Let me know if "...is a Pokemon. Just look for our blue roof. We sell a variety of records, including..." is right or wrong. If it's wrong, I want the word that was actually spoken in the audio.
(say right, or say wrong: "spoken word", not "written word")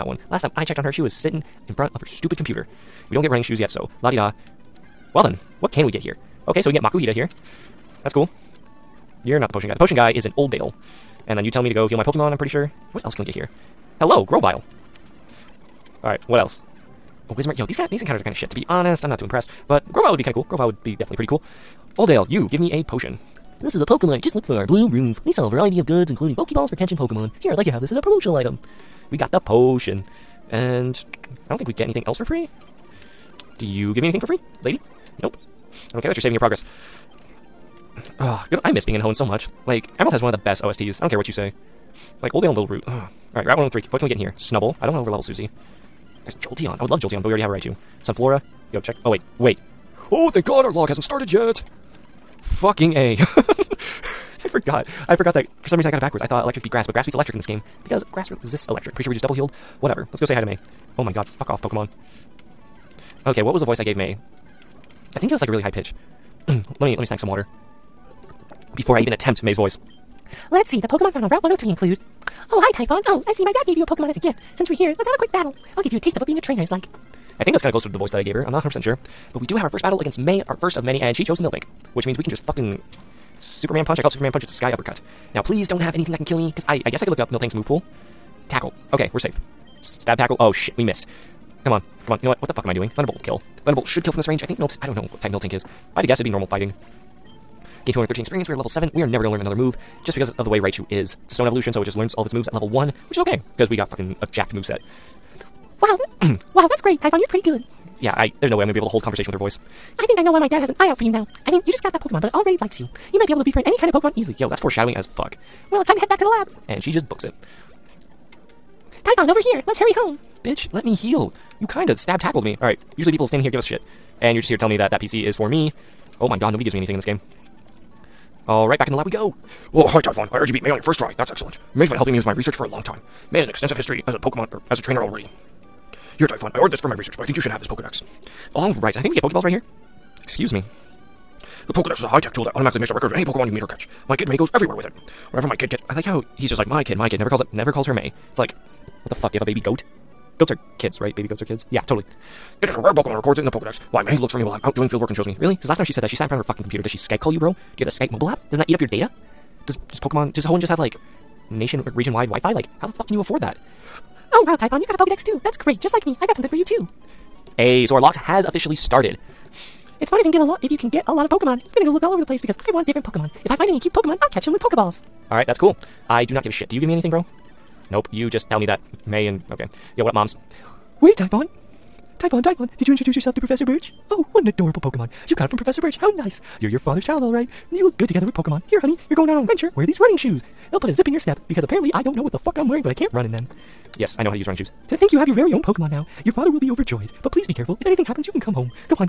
wrong: "goods", not "records".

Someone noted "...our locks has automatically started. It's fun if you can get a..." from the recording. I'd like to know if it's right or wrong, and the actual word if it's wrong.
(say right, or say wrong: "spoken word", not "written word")
wrong: "officially", not "automatically".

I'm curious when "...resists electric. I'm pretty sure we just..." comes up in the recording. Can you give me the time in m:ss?
0:58.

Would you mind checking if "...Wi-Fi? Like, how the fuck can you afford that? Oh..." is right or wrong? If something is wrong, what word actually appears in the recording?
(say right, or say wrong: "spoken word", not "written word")
right.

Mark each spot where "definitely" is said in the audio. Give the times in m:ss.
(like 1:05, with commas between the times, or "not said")
0:20.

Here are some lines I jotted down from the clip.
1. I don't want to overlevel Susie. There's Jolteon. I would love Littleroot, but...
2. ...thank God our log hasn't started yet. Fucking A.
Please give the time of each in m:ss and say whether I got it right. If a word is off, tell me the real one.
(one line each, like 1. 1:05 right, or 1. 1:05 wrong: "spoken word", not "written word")
1. 0:44 wrong: "Jolteon", not "Littleroot"
2. 0:50 right.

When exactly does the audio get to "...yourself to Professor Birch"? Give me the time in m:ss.
3:03.